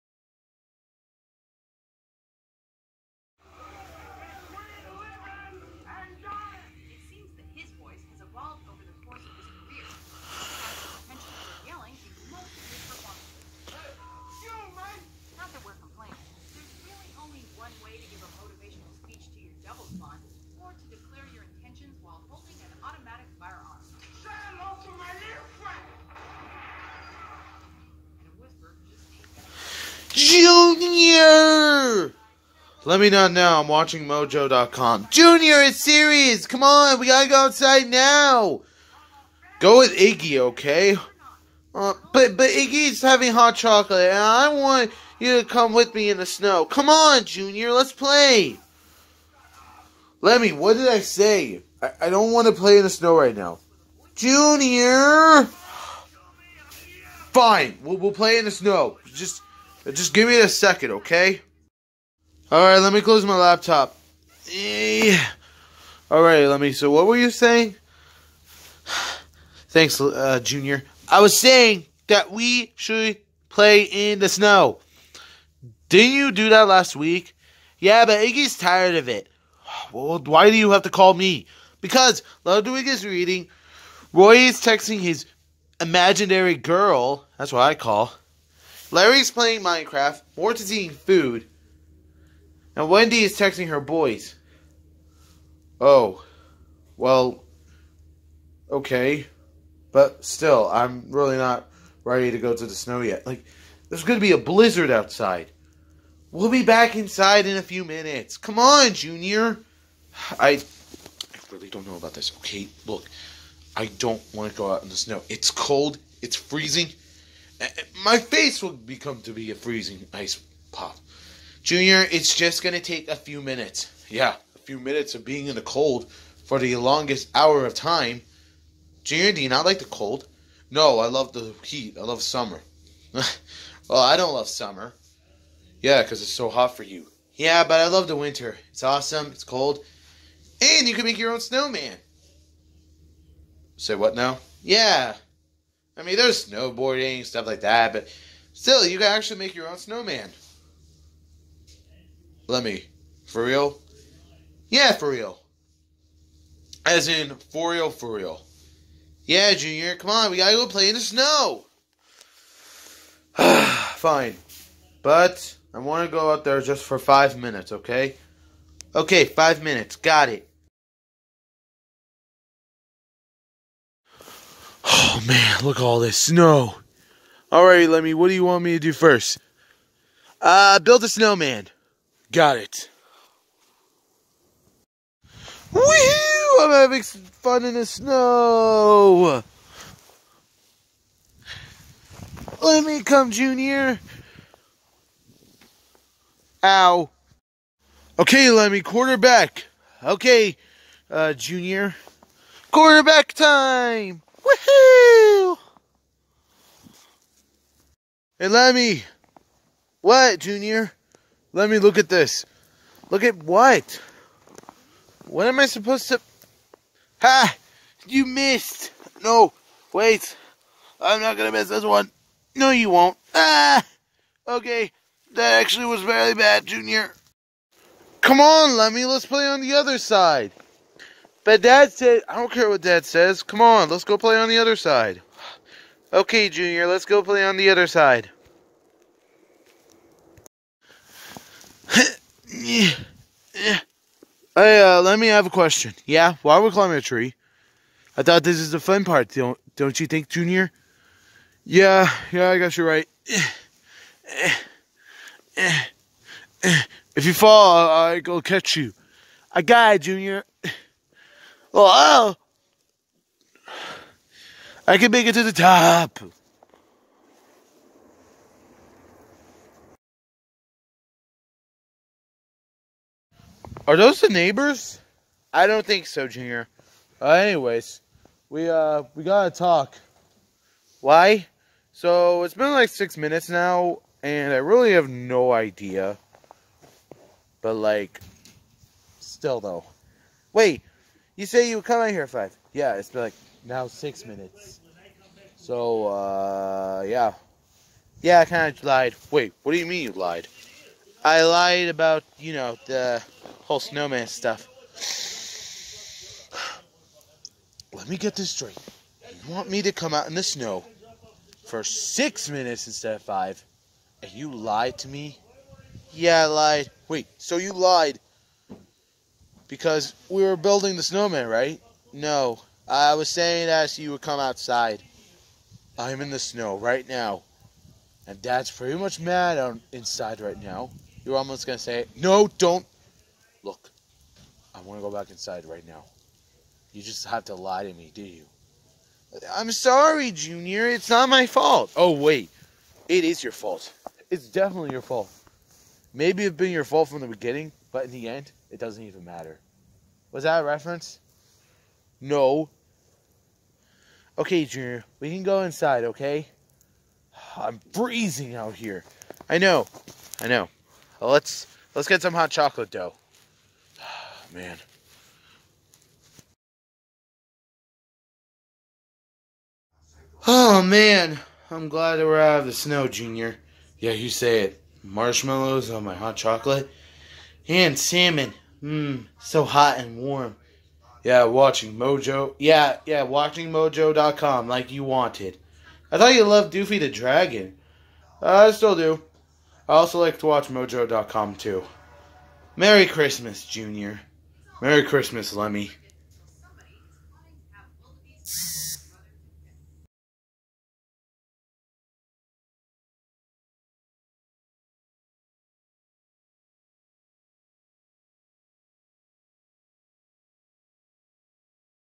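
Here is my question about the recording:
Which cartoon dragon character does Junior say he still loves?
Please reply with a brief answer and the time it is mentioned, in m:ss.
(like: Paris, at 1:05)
Doofy the Dragon, at 6:26.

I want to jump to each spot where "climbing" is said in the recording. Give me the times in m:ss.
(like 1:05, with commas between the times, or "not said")
4:06.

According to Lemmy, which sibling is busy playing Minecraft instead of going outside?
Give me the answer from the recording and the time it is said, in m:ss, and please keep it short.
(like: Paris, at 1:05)
Larry, at 1:28.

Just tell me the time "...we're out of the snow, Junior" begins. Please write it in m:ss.
6:12.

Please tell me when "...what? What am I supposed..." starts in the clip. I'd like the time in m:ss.
3:33.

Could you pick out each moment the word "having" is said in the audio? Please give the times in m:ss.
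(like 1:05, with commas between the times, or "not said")
0:43, 3:06.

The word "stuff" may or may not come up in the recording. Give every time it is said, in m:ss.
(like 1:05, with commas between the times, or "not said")
2:27, 5:04.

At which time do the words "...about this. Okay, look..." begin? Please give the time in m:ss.
1:51.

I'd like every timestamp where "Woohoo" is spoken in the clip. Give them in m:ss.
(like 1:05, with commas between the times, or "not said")
3:05, 3:24.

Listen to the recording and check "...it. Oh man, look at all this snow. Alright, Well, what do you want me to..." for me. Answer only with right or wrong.
wrong.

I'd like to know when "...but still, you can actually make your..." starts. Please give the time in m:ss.
2:27.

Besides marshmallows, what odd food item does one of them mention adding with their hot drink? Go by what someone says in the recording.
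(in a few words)
Salmon.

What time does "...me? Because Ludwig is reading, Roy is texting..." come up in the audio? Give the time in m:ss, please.
1:21.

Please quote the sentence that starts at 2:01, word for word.
Junior, it's just going to take a few minutes.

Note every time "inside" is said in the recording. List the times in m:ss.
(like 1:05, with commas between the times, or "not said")
1:46, 5:29, 5:35, 5:55.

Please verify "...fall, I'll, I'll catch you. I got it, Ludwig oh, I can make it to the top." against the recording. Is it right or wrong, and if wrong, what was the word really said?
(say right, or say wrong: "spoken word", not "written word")
wrong: "Junior", not "Ludwig".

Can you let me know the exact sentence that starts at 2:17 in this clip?
Yeah, but I love the winter.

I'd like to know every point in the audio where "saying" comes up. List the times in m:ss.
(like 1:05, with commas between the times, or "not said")
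1:07, 1:11, 5:23.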